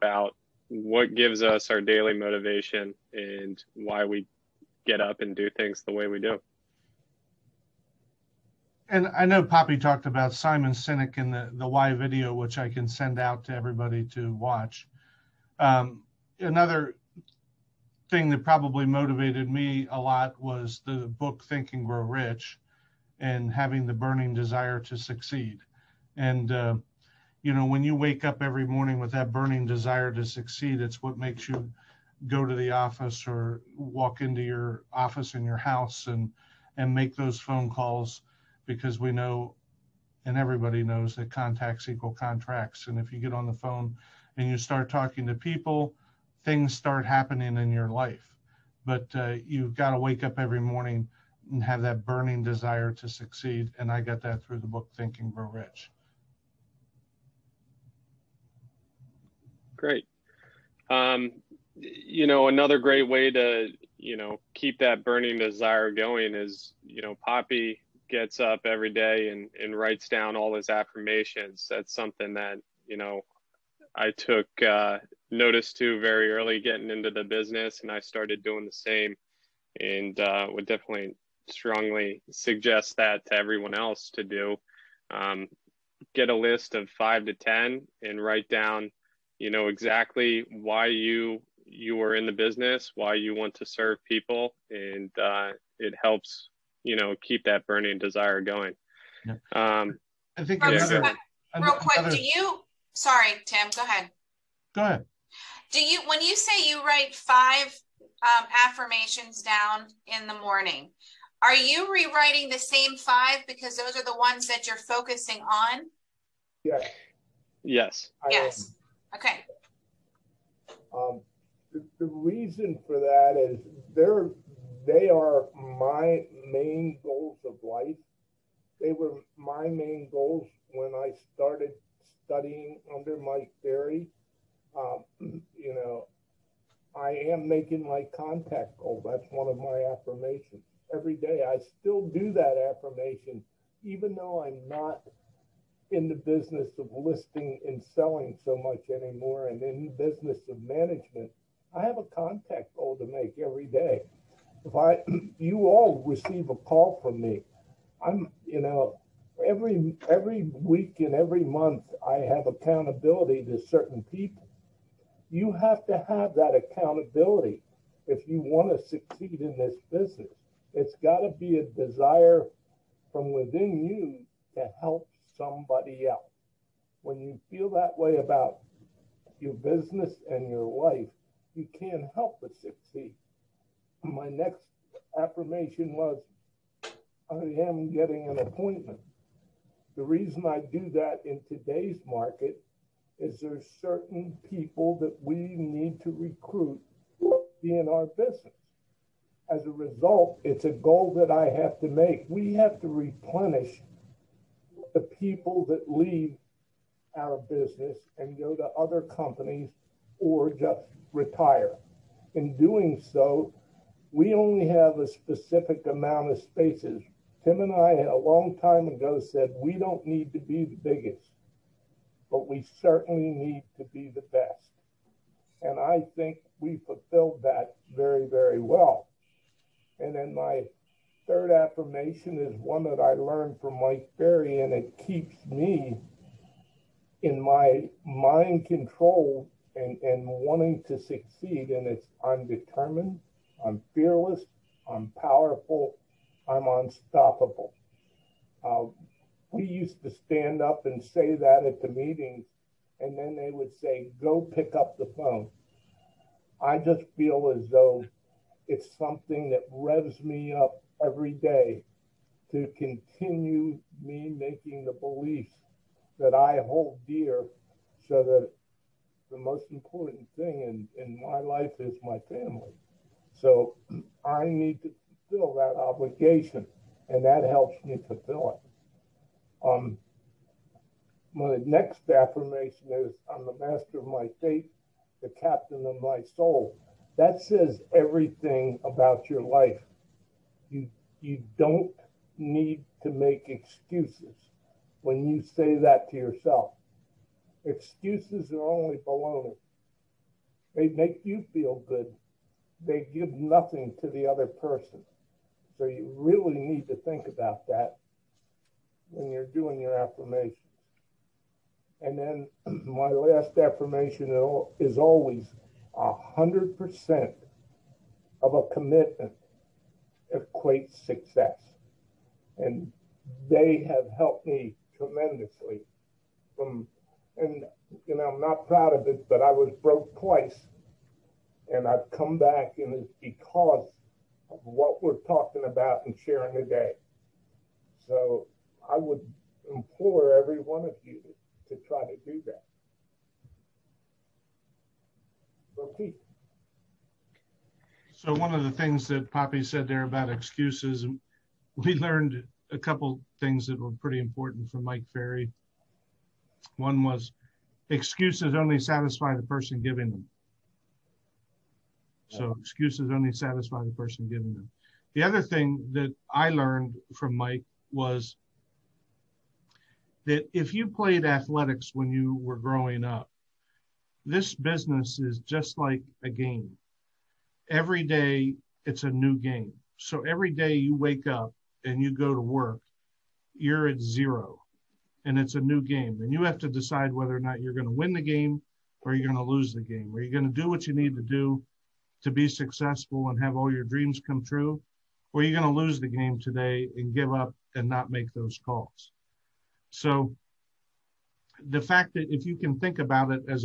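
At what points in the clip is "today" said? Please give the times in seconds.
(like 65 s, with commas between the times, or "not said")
191 s, 336 s, 396 s.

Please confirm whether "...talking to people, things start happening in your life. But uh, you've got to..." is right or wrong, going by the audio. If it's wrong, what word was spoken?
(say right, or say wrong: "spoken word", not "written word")
right.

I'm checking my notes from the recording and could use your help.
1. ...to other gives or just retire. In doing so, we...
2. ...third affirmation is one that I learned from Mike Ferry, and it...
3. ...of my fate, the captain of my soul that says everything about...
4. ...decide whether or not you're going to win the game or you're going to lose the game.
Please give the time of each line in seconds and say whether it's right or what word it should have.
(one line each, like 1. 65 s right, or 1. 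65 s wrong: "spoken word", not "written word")
1. 208 s wrong: "companies", not "gives"
2. 231 s right
3. 283 s right
4. 386 s right.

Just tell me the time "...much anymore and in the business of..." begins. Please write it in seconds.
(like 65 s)
148 s.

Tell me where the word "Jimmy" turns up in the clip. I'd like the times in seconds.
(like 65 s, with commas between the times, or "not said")
not said.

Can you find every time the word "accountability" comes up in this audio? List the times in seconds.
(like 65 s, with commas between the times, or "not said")
162 s, 166 s.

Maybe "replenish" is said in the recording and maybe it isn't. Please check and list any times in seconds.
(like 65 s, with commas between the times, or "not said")
202 s.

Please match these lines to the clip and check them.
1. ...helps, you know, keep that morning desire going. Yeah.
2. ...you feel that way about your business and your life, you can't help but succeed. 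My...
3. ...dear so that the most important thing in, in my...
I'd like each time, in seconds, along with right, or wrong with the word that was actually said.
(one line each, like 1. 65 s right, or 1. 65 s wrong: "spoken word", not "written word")
1. 96 s wrong: "burning", not "morning"
2. 177 s right
3. 267 s right.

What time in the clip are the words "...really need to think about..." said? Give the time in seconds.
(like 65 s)
306 s.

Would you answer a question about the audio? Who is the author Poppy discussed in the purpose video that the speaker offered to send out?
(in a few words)
Simon Sinek.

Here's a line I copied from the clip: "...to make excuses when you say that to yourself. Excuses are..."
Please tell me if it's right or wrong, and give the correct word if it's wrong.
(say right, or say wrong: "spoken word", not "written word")
right.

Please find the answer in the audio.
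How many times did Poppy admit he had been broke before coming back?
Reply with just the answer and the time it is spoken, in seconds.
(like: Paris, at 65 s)
2, at 330 s.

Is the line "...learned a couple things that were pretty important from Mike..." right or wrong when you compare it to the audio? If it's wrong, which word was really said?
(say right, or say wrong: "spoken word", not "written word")
right.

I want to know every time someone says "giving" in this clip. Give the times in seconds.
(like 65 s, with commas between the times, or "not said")
359 s, 364 s.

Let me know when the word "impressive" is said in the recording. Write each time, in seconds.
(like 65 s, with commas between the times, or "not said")
not said.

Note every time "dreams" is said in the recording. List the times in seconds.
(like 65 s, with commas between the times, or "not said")
393 s.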